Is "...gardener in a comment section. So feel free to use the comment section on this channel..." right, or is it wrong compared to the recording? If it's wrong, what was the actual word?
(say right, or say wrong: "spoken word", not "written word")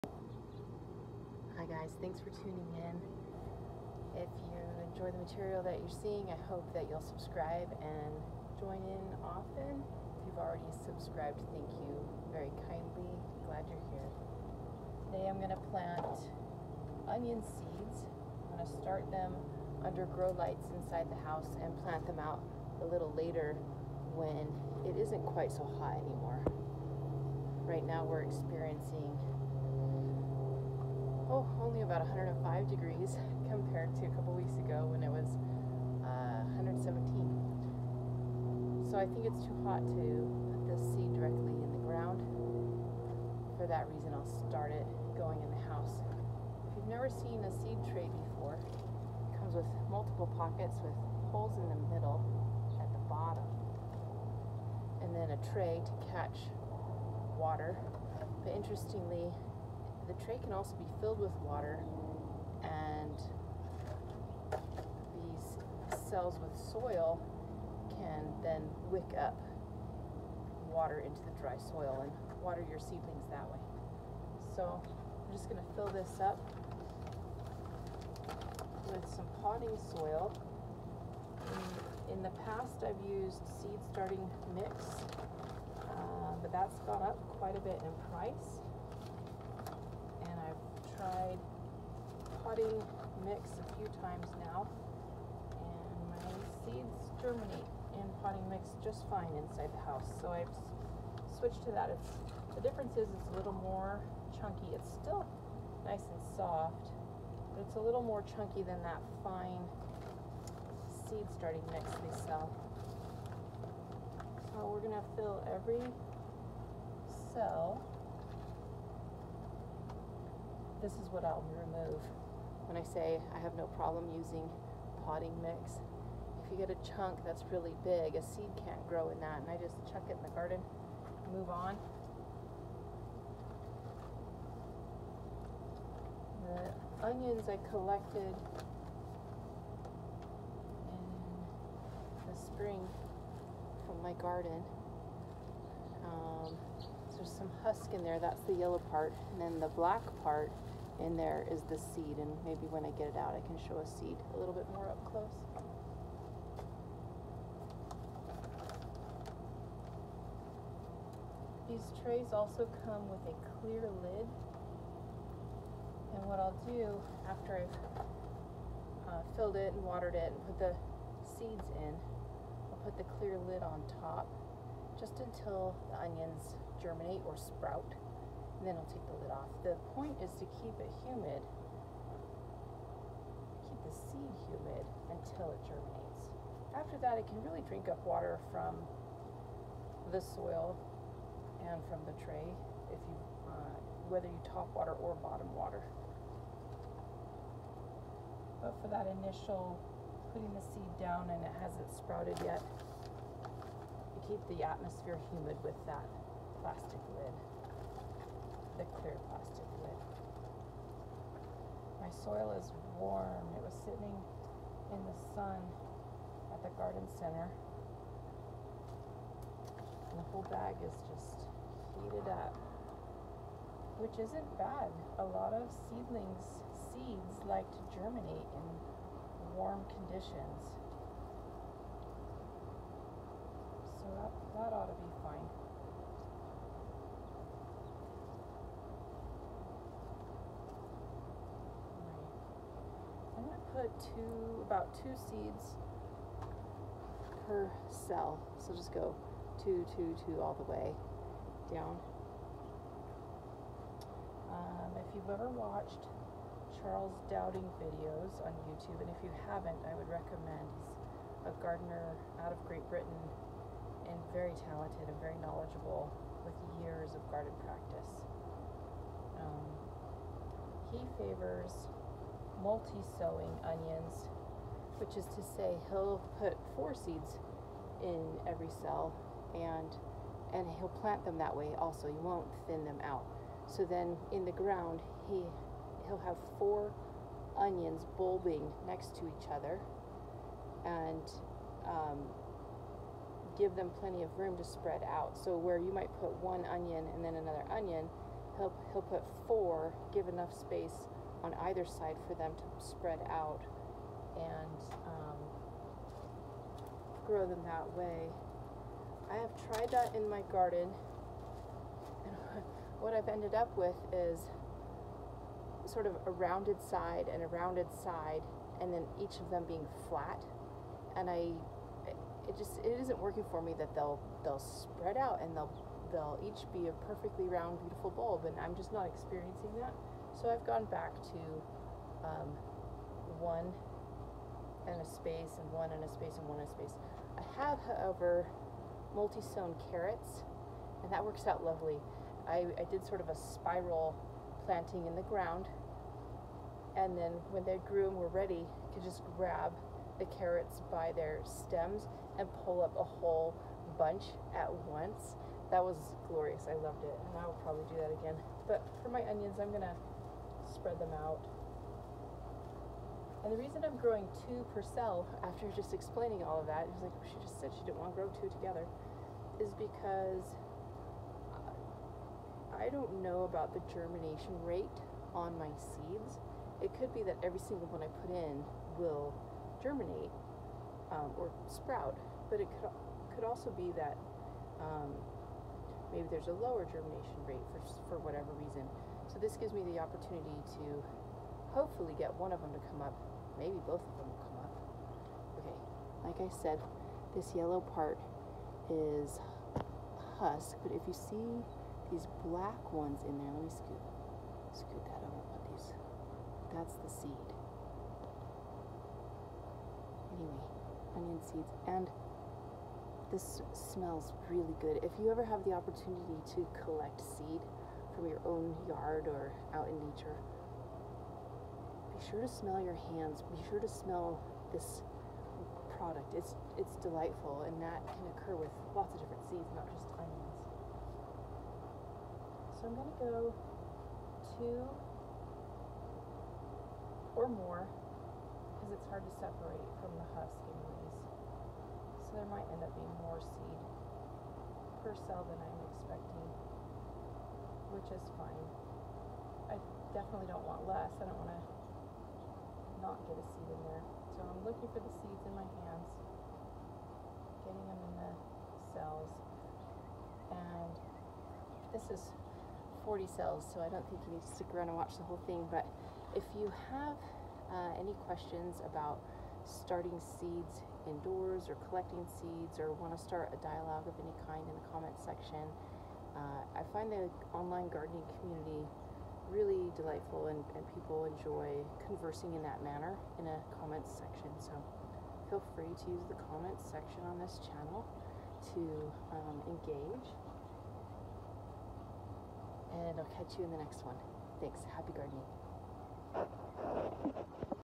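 wrong: "manner", not "gardener".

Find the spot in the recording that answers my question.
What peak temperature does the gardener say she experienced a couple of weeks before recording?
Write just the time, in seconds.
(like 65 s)
36 s.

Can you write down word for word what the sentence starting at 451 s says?
I don't want to not get a seed in there.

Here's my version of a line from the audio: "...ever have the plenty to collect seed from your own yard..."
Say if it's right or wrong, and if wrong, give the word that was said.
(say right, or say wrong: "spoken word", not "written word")
wrong: "opportunity", not "plenty".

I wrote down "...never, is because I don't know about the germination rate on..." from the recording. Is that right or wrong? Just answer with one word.
wrong.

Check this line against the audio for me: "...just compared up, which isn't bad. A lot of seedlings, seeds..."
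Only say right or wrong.
wrong.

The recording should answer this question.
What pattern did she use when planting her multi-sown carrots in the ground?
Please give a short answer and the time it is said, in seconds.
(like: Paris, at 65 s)
spiral, at 343 s.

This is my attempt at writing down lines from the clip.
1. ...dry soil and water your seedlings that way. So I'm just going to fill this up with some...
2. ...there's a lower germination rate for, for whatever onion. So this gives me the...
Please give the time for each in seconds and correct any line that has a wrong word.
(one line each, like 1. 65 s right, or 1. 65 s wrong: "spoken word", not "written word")
1. 71 s right
2. 386 s wrong: "reason", not "onion".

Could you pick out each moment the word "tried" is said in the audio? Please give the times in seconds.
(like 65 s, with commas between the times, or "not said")
91 s, 309 s.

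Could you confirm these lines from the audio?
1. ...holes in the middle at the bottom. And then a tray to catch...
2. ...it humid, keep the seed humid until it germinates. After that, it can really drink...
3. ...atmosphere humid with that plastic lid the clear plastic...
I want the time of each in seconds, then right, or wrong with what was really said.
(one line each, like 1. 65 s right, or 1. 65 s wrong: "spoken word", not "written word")
1. 51 s right
2. 180 s right
3. 204 s right.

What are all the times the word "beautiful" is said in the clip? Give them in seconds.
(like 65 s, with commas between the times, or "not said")
327 s.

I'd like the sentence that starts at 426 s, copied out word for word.
It's it's delightful and that can occur with lots of different seeds, not just onions.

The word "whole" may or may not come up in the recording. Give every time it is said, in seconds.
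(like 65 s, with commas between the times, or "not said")
220 s, 353 s, 465 s.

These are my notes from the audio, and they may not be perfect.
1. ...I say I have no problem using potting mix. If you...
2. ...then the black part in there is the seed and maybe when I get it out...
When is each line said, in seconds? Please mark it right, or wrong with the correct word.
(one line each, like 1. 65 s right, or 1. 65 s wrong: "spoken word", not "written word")
1. 122 s right
2. 149 s right.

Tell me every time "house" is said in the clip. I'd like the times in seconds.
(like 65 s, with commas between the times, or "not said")
21 s, 45 s, 99 s.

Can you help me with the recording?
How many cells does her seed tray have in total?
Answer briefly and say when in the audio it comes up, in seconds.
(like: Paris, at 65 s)
40, at 463 s.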